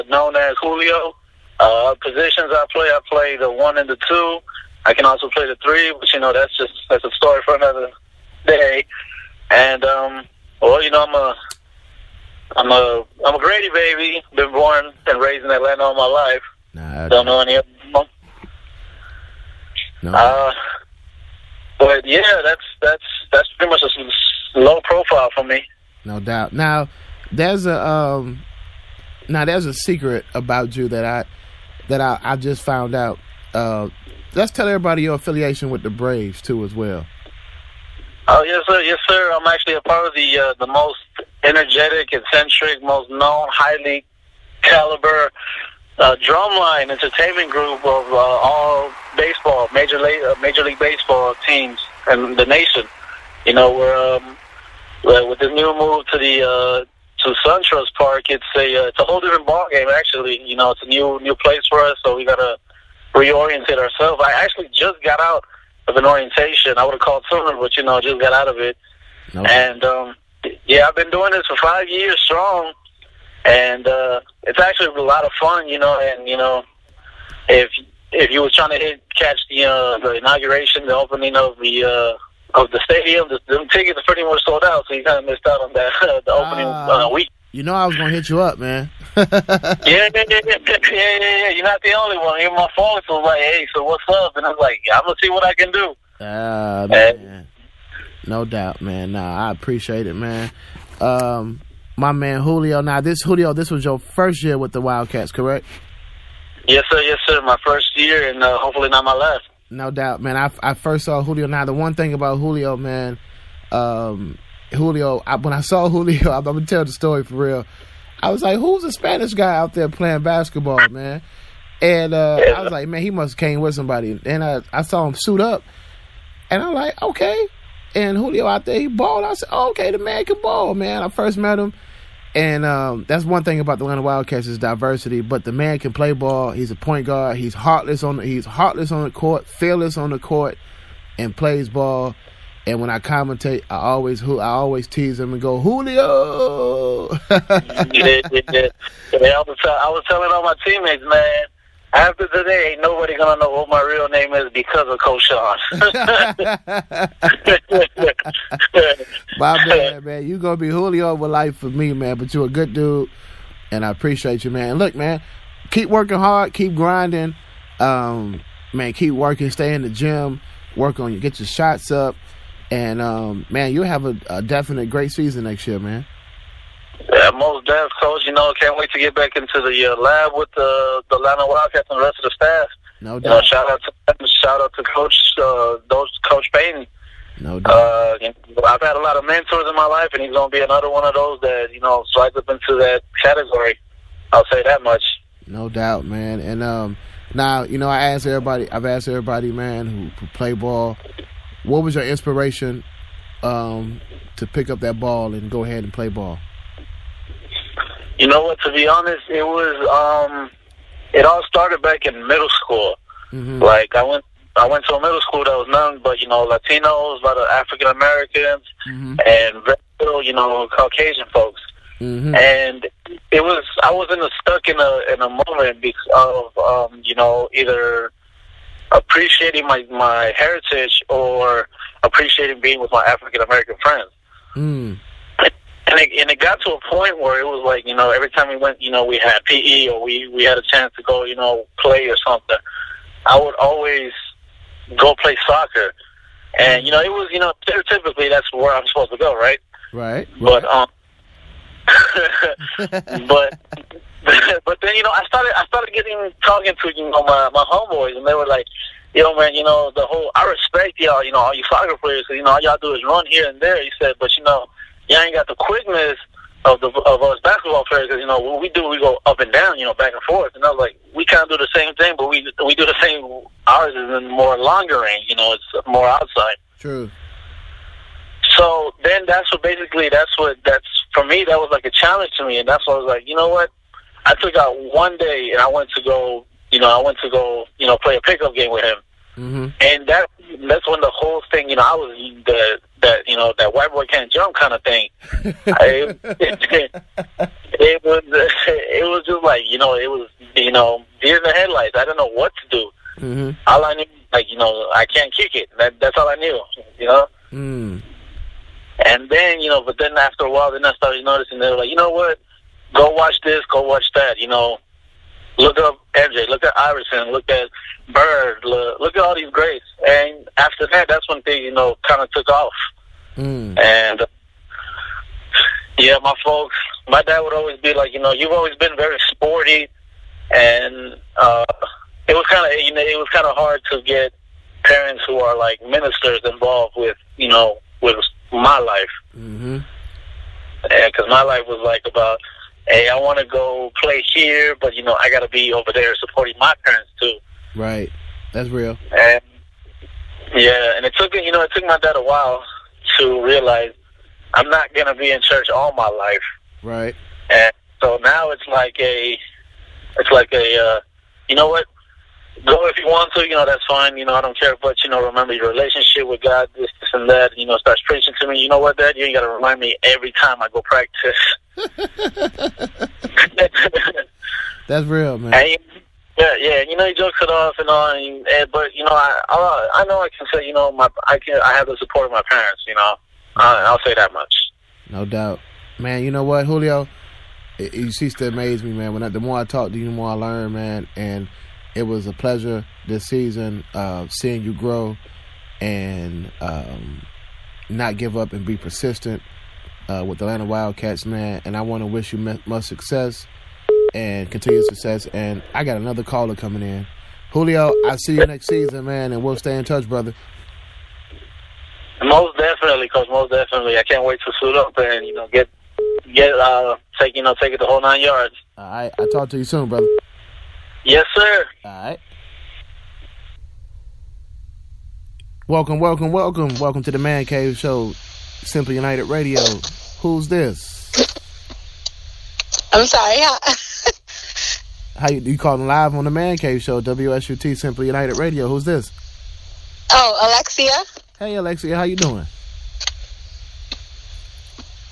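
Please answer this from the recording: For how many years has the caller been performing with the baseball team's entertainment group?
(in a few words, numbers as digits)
5.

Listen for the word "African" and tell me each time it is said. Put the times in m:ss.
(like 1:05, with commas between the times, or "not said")
3:37, 3:53.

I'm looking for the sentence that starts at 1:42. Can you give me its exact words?
Now, this Julio, this was your first year with the Wildcats, correct?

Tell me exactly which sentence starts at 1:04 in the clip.
I actually just got out of an orientation.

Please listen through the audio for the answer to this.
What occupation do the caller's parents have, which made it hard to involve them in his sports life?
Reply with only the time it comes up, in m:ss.
5:35.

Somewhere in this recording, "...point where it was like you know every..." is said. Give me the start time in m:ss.
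3:56.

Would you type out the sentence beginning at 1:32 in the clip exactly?
Even my phone was like, "Hey, so what's up?" And I'm like, "I'm gonna see what I can do." Ah, uh, man.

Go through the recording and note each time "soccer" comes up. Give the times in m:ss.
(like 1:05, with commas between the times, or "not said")
4:05, 4:21.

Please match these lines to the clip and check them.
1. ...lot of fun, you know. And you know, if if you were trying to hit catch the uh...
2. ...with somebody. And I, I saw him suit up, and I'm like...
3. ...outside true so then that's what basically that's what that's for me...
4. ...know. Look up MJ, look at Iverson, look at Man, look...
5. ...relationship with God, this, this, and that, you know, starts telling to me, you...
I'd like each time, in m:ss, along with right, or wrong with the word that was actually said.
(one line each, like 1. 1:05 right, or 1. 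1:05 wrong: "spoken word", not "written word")
1. 1:15 right
2. 2:03 right
3. 4:36 right
4. 5:14 wrong: "Bird", not "Man"
5. 6:05 wrong: "preaching", not "telling".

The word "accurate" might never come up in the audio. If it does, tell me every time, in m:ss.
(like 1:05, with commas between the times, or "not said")
not said.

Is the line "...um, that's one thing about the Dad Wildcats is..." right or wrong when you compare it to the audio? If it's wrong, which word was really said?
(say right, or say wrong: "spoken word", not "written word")
wrong: "Atlanta", not "Dad".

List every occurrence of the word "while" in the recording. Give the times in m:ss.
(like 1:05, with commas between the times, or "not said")
5:10, 5:52.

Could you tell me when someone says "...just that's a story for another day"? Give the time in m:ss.
0:06.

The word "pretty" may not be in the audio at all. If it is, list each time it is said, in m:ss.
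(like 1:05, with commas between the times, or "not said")
0:23, 1:24.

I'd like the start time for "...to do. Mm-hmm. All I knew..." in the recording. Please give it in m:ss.
5:02.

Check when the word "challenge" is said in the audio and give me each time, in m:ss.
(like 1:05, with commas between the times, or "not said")
4:41.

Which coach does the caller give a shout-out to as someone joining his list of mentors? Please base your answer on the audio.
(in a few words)
Coach Payton.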